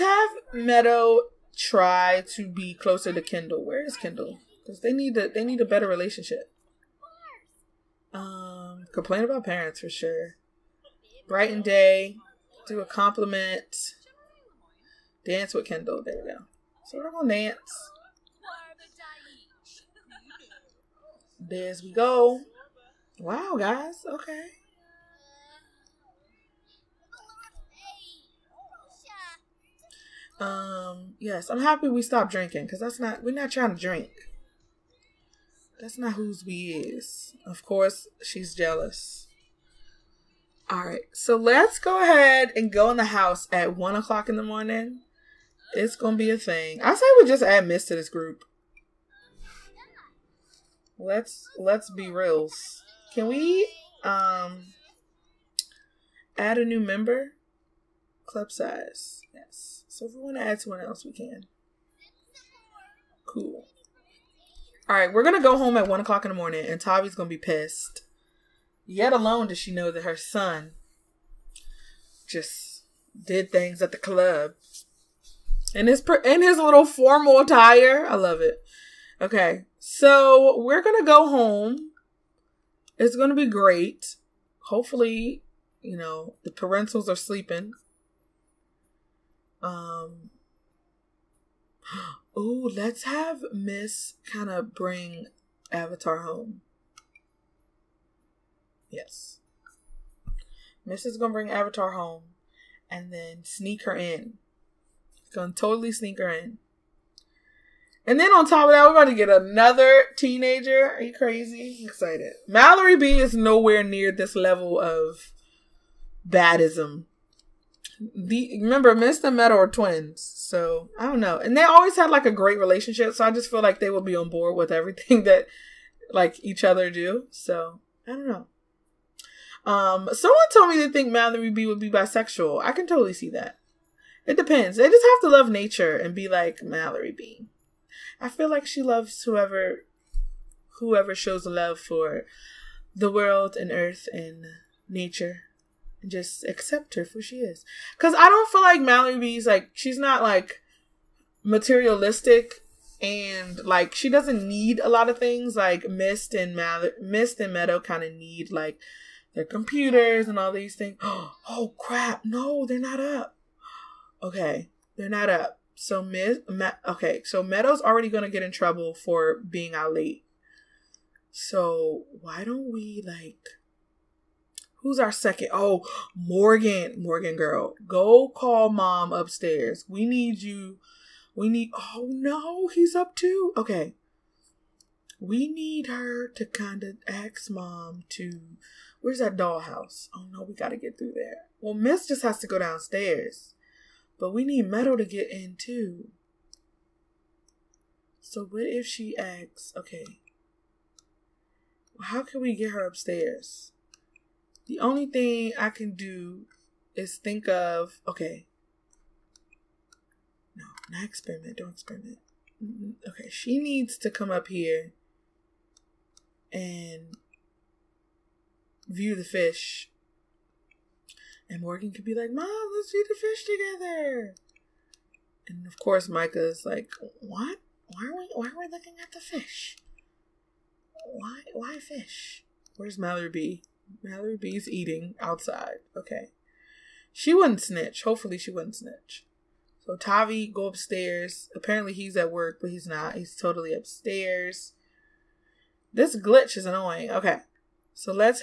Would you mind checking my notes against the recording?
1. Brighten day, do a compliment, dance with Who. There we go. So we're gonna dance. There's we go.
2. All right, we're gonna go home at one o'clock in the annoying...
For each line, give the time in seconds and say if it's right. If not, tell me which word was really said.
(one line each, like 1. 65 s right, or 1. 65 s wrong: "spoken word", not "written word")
1. 11 s wrong: "Kendall", not "Who"
2. 64 s wrong: "morning", not "annoying".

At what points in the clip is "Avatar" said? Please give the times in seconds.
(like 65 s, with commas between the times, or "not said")
95 s, 101 s.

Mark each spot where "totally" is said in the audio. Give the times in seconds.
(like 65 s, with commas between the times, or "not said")
105 s, 132 s, 243 s.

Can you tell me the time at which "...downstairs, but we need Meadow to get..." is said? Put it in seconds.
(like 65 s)
192 s.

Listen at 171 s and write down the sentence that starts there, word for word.
So why don't we like Who's our second?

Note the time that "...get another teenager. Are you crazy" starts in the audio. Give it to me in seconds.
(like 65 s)
109 s.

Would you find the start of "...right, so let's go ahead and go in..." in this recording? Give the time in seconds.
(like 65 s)
40 s.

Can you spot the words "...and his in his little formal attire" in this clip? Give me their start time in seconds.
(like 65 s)
75 s.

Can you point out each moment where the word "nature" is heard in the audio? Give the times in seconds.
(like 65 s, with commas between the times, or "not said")
135 s, 144 s.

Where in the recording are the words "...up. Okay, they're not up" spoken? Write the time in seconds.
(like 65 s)
163 s.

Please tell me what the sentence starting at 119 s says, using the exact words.
Meadow are twins, so I don't know.